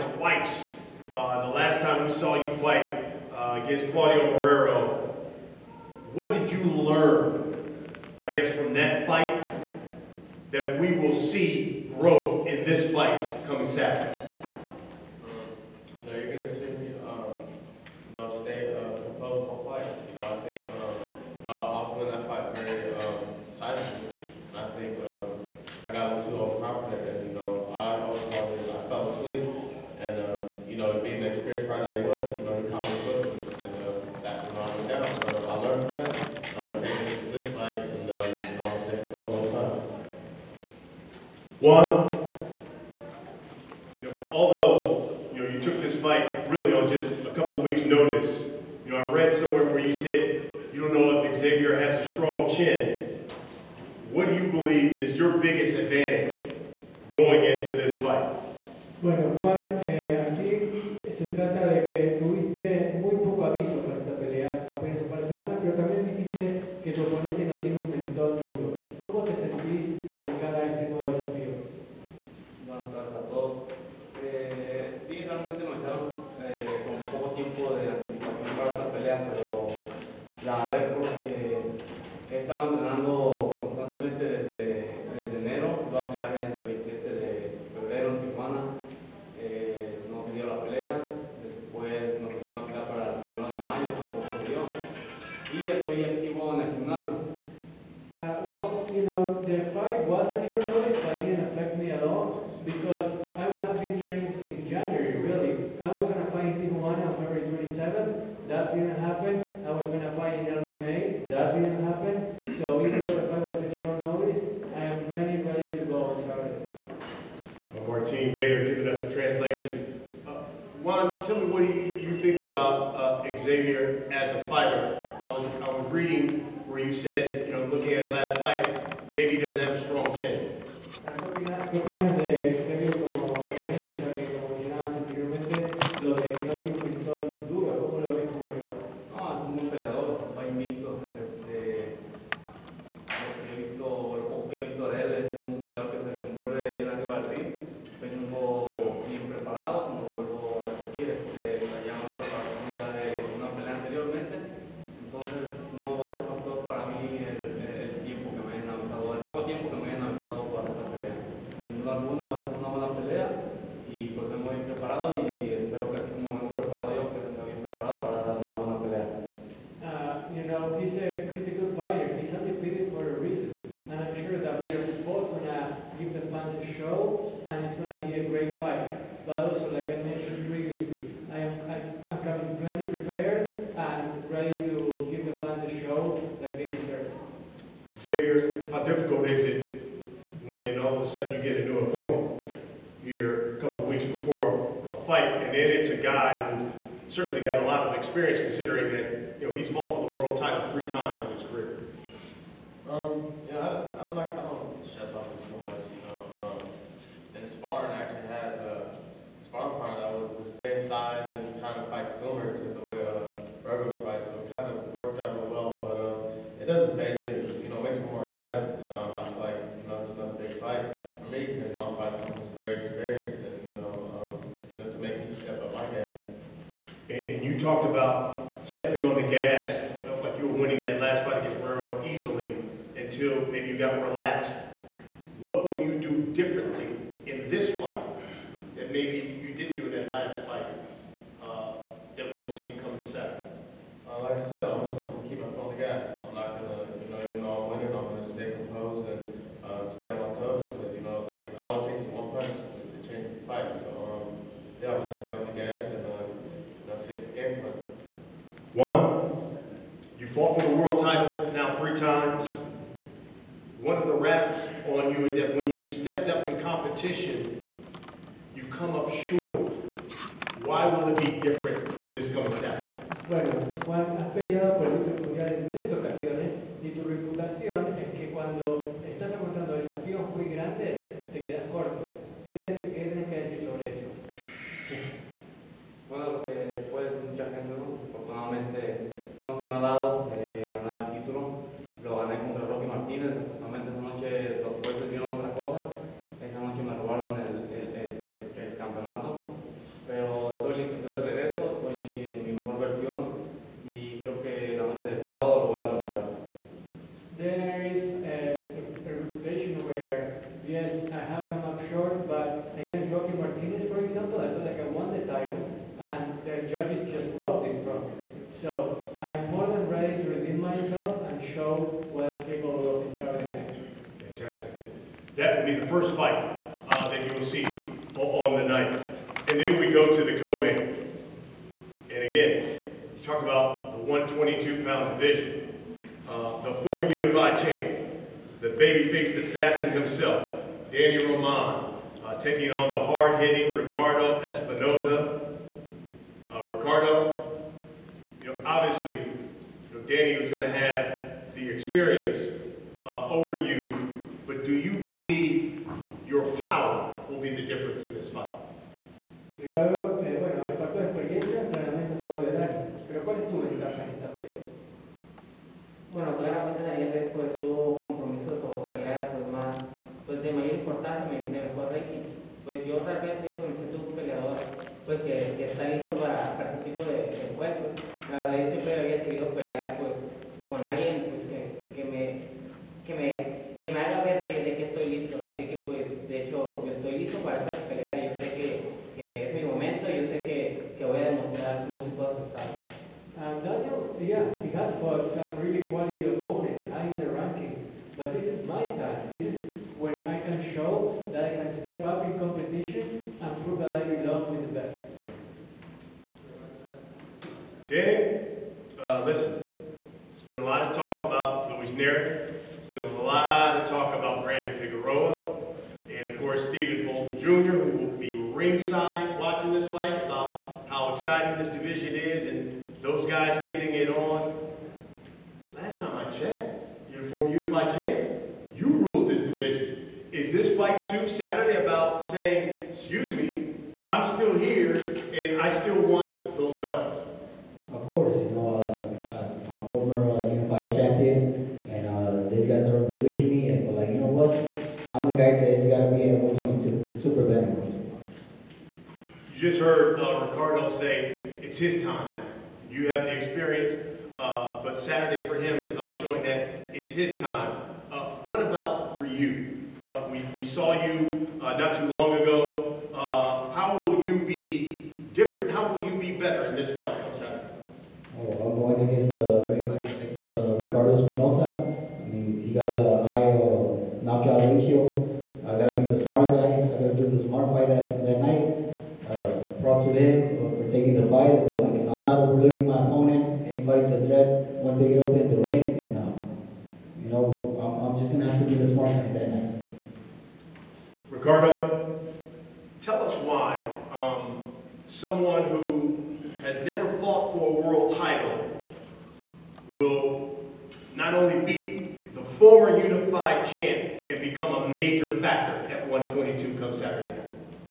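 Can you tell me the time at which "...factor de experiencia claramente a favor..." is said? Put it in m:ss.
6:00.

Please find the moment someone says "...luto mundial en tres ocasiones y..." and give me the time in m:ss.
4:34.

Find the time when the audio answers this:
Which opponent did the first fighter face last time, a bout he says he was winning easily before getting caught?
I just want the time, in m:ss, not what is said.
0:03.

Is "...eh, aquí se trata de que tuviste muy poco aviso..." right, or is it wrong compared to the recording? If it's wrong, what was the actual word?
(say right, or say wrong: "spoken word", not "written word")
right.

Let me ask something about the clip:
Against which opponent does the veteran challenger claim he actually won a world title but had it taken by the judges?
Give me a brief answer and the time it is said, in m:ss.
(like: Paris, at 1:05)
Rocky Martínez, at 4:52.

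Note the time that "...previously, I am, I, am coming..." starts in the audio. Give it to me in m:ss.
3:00.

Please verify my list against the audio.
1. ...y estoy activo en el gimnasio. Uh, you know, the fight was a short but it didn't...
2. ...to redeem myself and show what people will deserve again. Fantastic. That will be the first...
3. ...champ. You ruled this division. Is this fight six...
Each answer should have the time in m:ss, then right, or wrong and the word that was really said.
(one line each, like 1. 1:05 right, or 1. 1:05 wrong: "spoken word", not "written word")
1. 1:35 right
2. 5:20 right
3. 7:07 wrong: "two", not "six".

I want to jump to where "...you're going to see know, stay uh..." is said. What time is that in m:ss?
0:16.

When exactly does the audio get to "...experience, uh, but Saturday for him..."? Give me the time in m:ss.
7:33.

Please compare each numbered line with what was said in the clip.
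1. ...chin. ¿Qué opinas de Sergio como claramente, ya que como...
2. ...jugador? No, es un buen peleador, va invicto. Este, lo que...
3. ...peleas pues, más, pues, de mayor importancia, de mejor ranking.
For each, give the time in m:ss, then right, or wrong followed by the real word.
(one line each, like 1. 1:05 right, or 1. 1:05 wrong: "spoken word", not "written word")
1. 2:10 wrong: "componente", not "claramente"
2. 2:18 right
3. 6:08 right.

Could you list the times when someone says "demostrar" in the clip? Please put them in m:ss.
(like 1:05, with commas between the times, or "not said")
5:05, 6:31.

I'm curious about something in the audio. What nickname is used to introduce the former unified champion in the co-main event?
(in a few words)
the baby-faced assassin.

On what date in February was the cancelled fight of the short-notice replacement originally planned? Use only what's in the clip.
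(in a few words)
February 27.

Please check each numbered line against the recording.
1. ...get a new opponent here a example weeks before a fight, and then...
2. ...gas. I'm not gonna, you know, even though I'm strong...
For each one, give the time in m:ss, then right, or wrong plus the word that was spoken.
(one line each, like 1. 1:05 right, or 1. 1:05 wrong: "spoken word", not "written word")
1. 3:11 wrong: "couple", not "example"
2. 4:05 wrong: "winning", not "strong".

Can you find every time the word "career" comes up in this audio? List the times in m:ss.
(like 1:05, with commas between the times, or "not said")
3:21.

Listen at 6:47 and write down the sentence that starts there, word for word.
Danny, uh, listen, it has been a lot of talk about Louis Nery.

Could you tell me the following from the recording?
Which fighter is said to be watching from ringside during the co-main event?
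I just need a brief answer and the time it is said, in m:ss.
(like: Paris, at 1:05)
Stephen Fulton Jr., at 6:56.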